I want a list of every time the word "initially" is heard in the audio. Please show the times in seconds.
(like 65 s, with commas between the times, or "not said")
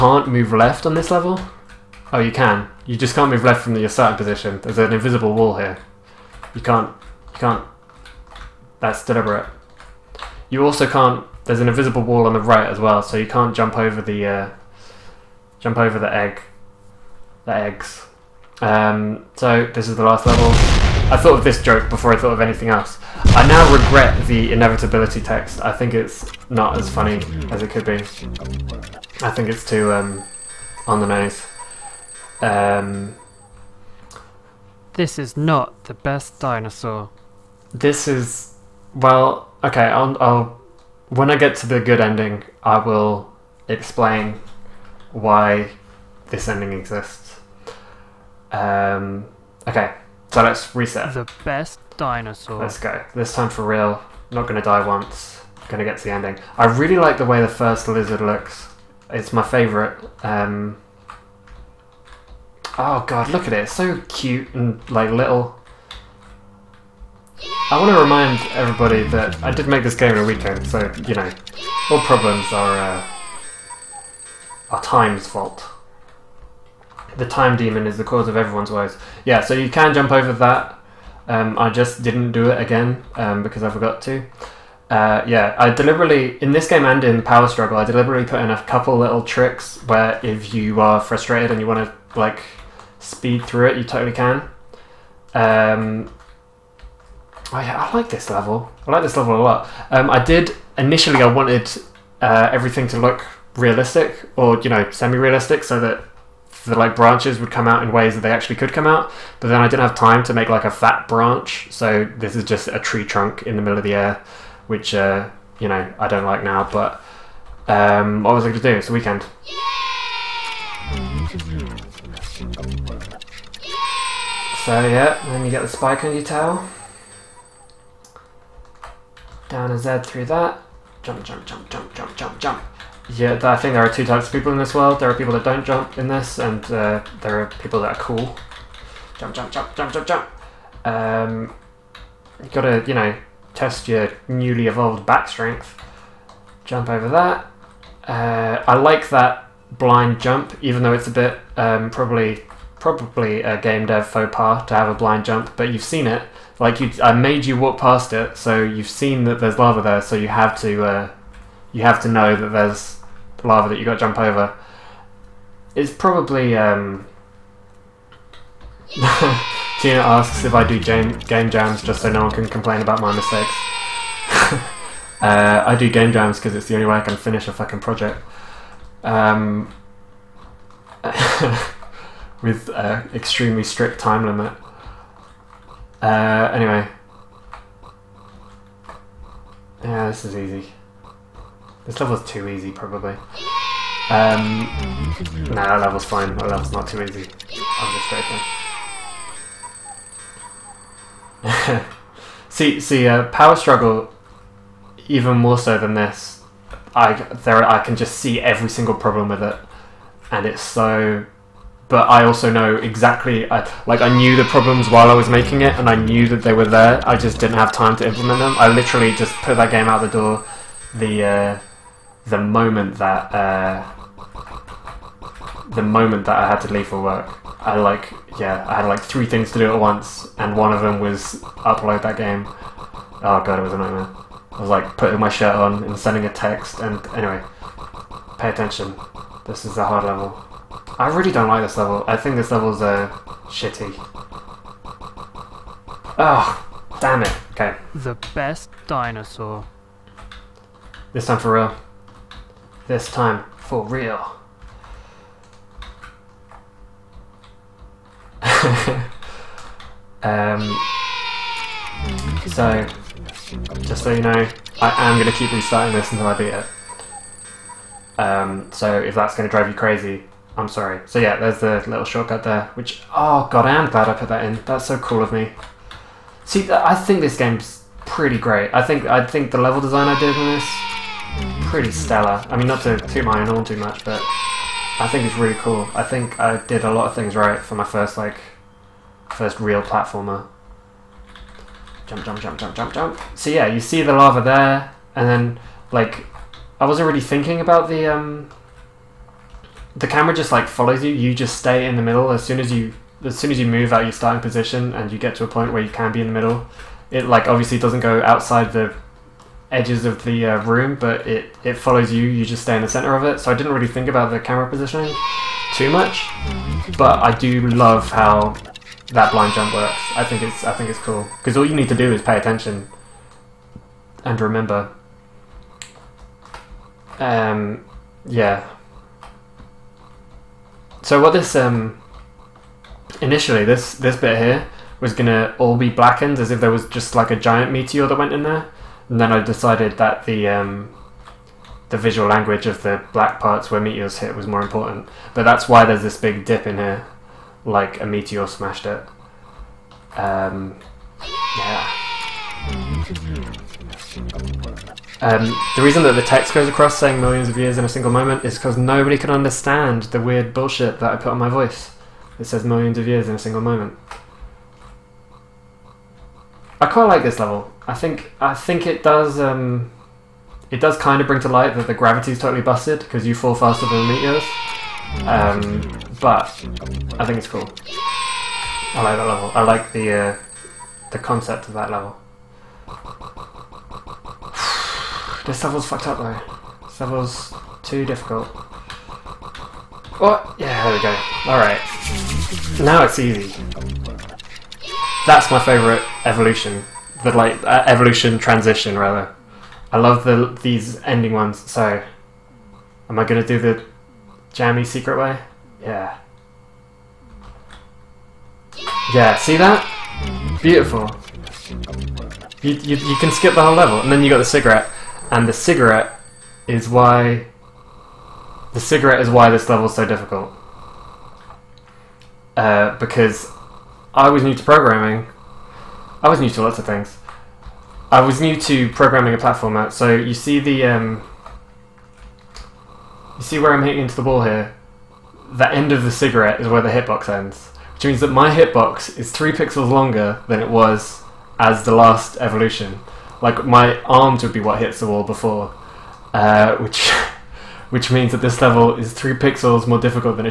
100 s, 333 s.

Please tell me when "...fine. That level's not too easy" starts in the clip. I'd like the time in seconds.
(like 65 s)
196 s.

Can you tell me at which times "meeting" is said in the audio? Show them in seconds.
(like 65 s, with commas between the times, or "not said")
not said.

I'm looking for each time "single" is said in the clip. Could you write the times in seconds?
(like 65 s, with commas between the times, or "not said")
208 s, 357 s, 363 s.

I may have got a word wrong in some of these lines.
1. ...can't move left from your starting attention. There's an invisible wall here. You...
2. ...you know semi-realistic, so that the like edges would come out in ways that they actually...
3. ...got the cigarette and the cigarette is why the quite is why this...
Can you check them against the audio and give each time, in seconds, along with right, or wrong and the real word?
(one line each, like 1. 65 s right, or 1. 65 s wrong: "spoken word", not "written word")
1. 3 s wrong: "position", not "attention"
2. 104 s wrong: "branches", not "edges"
3. 414 s wrong: "cigarette", not "quite".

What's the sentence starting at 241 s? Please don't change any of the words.
I really don't like this level.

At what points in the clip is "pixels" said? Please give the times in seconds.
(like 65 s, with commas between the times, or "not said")
439 s, 449 s.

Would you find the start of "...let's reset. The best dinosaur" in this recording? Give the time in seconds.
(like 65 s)
50 s.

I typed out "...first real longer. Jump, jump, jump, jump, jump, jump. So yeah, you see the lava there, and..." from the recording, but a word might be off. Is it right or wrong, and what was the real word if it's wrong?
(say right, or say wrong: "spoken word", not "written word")
wrong: "platformer", not "longer".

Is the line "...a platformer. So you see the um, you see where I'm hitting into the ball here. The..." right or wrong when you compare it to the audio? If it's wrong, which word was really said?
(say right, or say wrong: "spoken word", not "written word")
right.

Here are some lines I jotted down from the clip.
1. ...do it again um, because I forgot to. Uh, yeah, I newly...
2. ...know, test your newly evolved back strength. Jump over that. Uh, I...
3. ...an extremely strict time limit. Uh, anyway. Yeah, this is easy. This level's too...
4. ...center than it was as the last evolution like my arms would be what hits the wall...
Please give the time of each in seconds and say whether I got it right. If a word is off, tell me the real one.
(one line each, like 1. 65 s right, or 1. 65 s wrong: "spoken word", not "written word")
1. 82 s wrong: "deliberately", not "newly"
2. 142 s right
3. 182 s right
4. 439 s wrong: "longer", not "center".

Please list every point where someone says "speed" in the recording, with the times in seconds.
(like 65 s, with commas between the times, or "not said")
93 s.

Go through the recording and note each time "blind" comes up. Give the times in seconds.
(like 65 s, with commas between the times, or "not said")
149 s, 154 s, 319 s.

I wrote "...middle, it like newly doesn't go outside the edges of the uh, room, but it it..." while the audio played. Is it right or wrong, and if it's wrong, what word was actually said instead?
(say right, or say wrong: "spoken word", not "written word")
wrong: "obviously", not "newly".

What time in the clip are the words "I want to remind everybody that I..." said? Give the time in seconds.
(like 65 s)
67 s.